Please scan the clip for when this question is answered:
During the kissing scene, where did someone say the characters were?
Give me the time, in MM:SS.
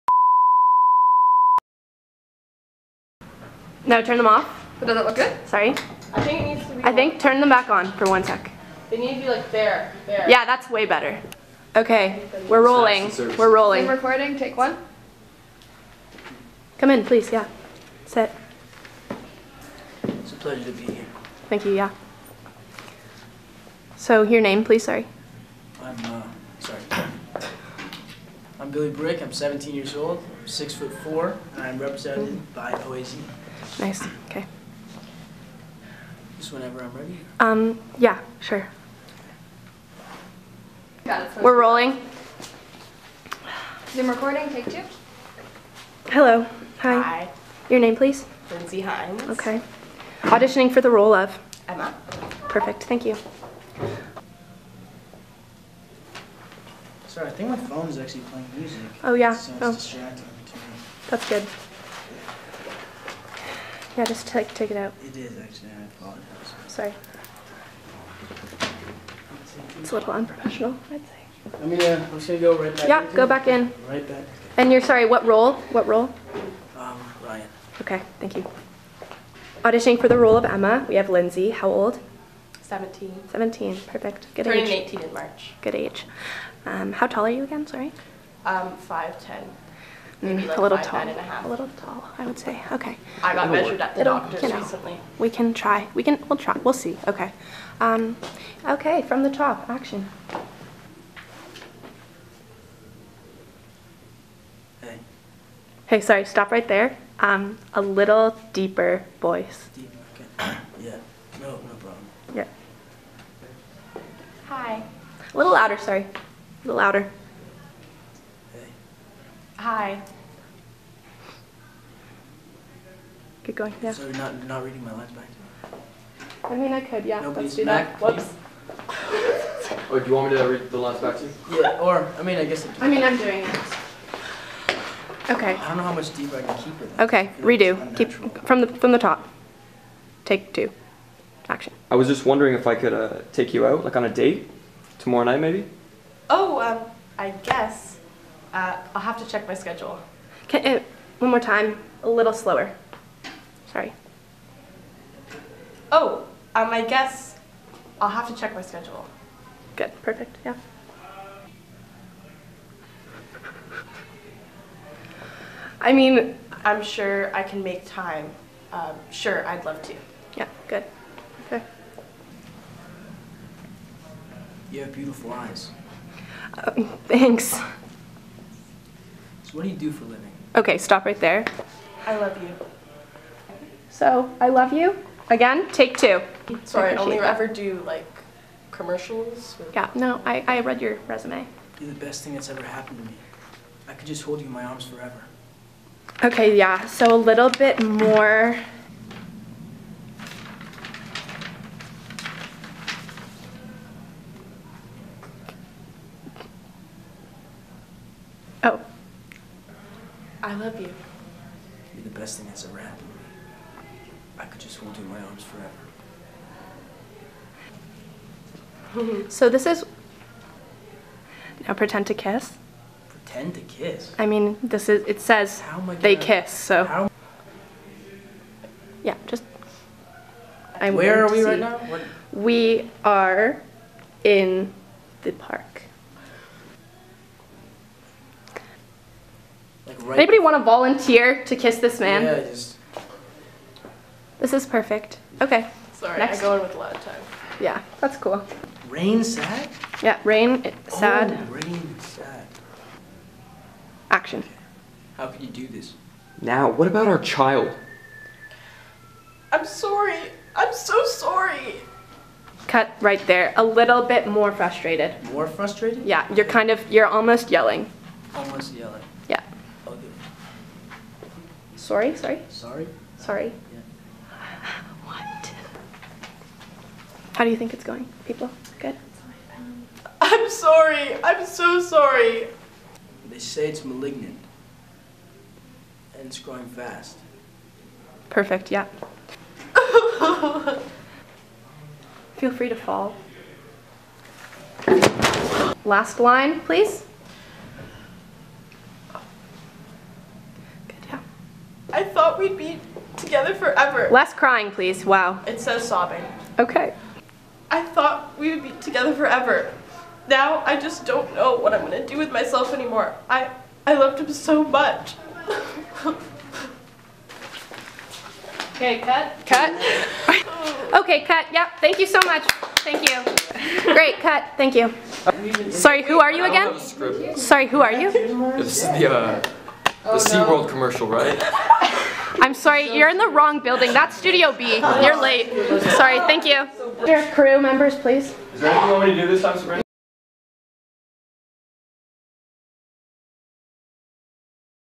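03:55.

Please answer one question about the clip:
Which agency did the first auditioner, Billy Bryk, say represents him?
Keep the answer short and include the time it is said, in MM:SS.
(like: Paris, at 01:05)
OAZ, at 00:32.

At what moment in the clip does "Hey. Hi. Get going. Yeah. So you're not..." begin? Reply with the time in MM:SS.
01:58.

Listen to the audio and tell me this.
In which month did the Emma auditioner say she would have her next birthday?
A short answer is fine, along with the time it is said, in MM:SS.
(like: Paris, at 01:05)
March, at 01:25.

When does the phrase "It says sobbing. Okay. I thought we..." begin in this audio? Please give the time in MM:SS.
05:05.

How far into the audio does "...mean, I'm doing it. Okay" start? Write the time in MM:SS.
02:12.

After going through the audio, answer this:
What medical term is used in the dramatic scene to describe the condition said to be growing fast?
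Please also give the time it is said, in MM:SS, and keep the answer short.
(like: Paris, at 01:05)
Malignant, at 04:43.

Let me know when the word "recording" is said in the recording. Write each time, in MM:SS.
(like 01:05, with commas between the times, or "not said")
00:13, 00:44.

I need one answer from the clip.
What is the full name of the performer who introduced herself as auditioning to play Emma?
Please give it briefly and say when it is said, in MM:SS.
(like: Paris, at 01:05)
Lindsey Hines, at 00:48.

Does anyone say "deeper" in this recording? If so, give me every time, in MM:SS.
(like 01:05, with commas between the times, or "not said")
01:48, 02:16.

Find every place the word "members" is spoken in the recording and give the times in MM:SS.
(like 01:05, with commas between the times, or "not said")
05:37.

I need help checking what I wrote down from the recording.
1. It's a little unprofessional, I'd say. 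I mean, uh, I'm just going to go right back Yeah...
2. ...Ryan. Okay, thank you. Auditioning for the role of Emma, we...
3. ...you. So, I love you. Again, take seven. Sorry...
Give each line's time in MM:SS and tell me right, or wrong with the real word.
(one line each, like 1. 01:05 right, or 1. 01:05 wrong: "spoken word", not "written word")
1. 01:09 right
2. 01:17 right
3. 03:02 wrong: "two", not "seven".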